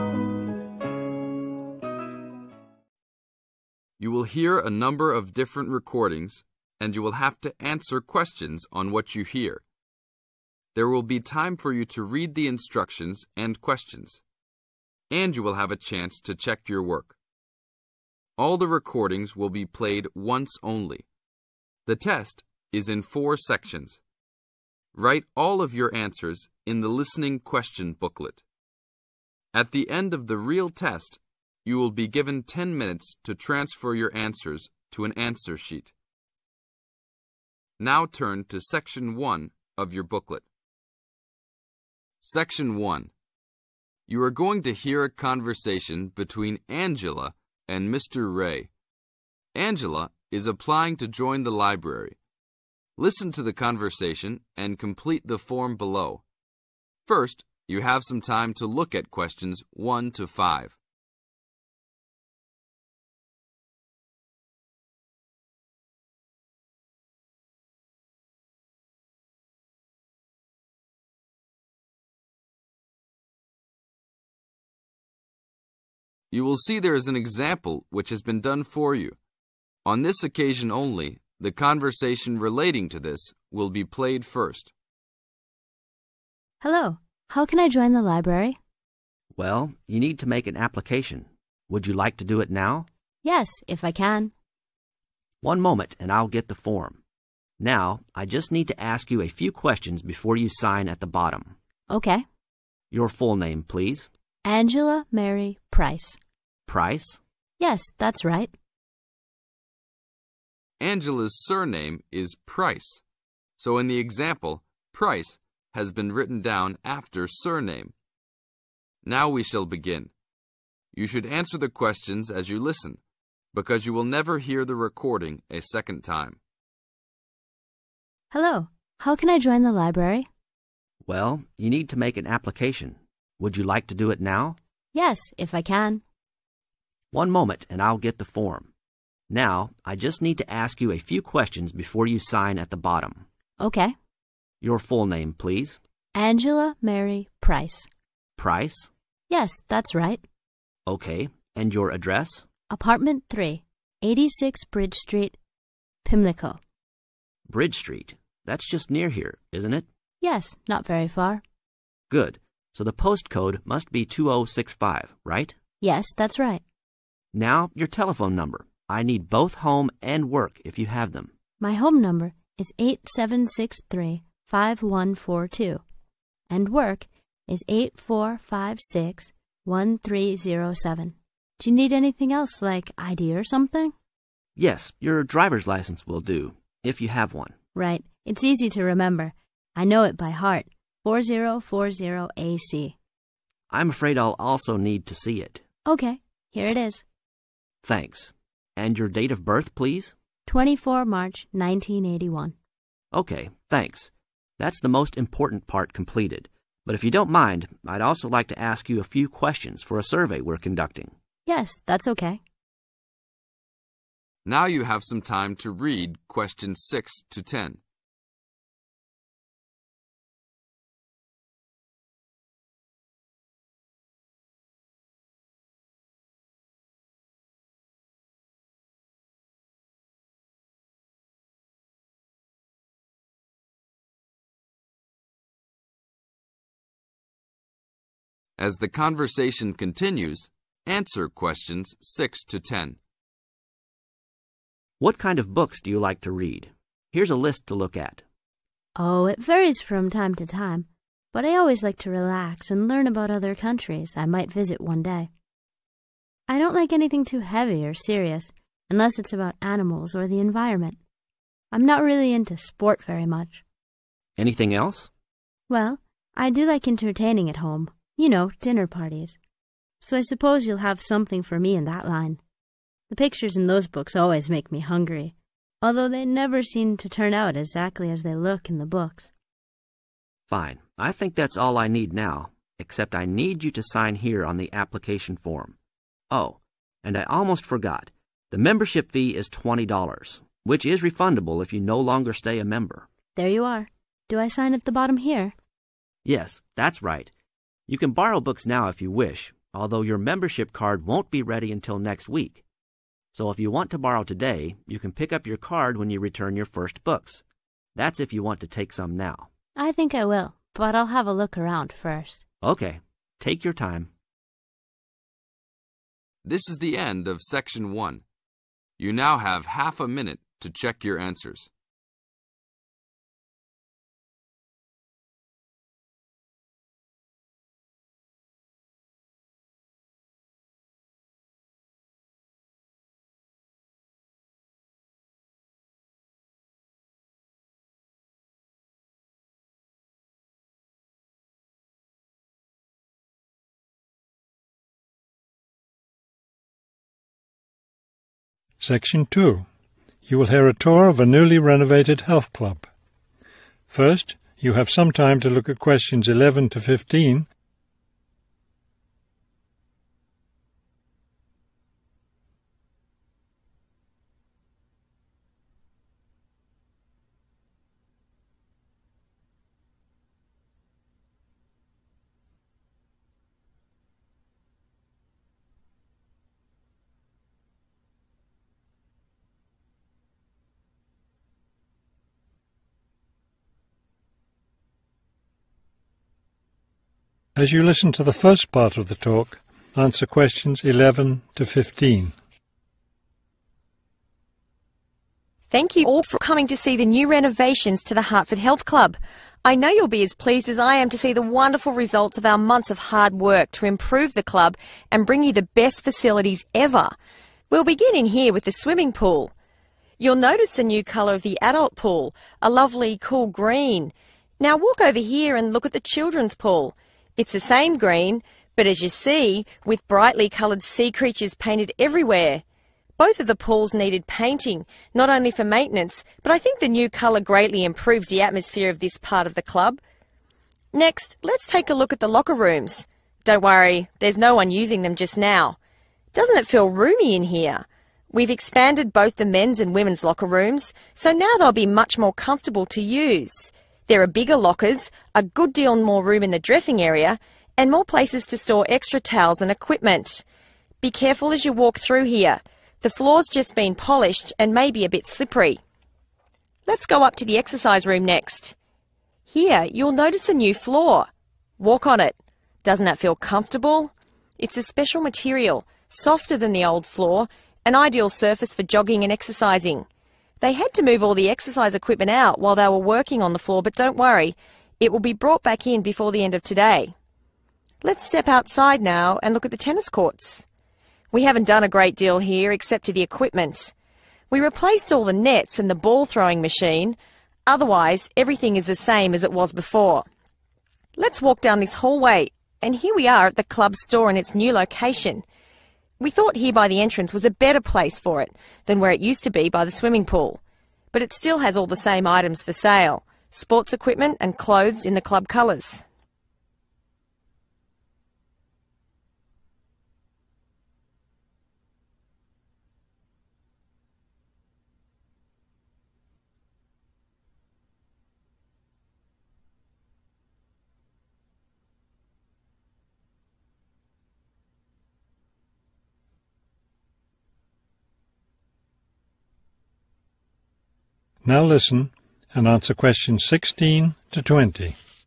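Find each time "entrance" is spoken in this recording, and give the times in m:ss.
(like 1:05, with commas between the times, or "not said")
8:17.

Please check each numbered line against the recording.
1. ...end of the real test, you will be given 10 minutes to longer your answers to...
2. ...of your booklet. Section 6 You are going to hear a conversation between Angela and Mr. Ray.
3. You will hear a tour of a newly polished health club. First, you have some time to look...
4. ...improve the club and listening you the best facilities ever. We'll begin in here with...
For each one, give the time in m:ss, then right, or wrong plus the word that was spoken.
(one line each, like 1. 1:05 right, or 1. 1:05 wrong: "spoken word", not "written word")
1. 0:29 wrong: "transfer", not "longer"
2. 0:39 wrong: "1", not "6"
3. 5:50 wrong: "renovated", not "polished"
4. 6:43 wrong: "bring", not "listening".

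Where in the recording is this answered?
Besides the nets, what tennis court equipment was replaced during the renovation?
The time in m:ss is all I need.
8:05.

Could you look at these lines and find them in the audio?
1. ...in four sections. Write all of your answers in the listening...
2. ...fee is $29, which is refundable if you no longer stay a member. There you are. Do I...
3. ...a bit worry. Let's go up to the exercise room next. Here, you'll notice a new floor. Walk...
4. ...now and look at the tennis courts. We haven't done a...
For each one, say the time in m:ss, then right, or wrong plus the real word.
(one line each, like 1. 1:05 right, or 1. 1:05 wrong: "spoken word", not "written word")
1. 0:22 right
2. 4:49 wrong: "20", not "29"
3. 7:35 wrong: "slippery", not "worry"
4. 7:59 right.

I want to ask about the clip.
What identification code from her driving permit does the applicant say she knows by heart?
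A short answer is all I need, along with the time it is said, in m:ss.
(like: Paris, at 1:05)
4040AC, at 3:11.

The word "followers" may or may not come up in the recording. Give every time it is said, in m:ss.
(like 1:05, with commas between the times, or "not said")
not said.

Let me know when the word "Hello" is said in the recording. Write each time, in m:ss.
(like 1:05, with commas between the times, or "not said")
1:26, 2:08.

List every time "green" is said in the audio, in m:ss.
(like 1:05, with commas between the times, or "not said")
6:53, 6:57.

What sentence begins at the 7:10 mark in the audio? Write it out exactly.
Next, let's take a look at the locker rooms.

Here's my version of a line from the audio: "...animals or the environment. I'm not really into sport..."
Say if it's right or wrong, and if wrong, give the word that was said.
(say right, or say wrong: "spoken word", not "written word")
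right.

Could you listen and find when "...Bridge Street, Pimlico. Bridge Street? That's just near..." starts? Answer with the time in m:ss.
2:34.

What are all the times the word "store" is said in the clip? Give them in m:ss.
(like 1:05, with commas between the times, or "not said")
7:28, 8:13.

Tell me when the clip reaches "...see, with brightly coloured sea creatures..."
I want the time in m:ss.
6:59.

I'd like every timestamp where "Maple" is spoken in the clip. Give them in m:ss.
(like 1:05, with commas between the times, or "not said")
not said.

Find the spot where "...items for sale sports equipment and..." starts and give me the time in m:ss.
8:22.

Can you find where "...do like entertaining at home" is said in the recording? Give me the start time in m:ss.
4:26.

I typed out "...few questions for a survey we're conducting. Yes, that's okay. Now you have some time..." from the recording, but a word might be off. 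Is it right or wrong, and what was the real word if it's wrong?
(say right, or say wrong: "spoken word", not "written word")
right.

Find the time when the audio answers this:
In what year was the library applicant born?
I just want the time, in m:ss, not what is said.
3:21.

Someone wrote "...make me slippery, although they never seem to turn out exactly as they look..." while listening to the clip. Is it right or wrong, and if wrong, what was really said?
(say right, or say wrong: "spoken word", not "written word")
wrong: "hungry", not "slippery".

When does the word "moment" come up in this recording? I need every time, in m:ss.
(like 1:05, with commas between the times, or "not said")
1:35, 2:17.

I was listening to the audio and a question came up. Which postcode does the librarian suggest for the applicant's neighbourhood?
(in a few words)
2065.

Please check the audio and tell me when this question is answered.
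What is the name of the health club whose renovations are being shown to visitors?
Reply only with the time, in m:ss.
6:38.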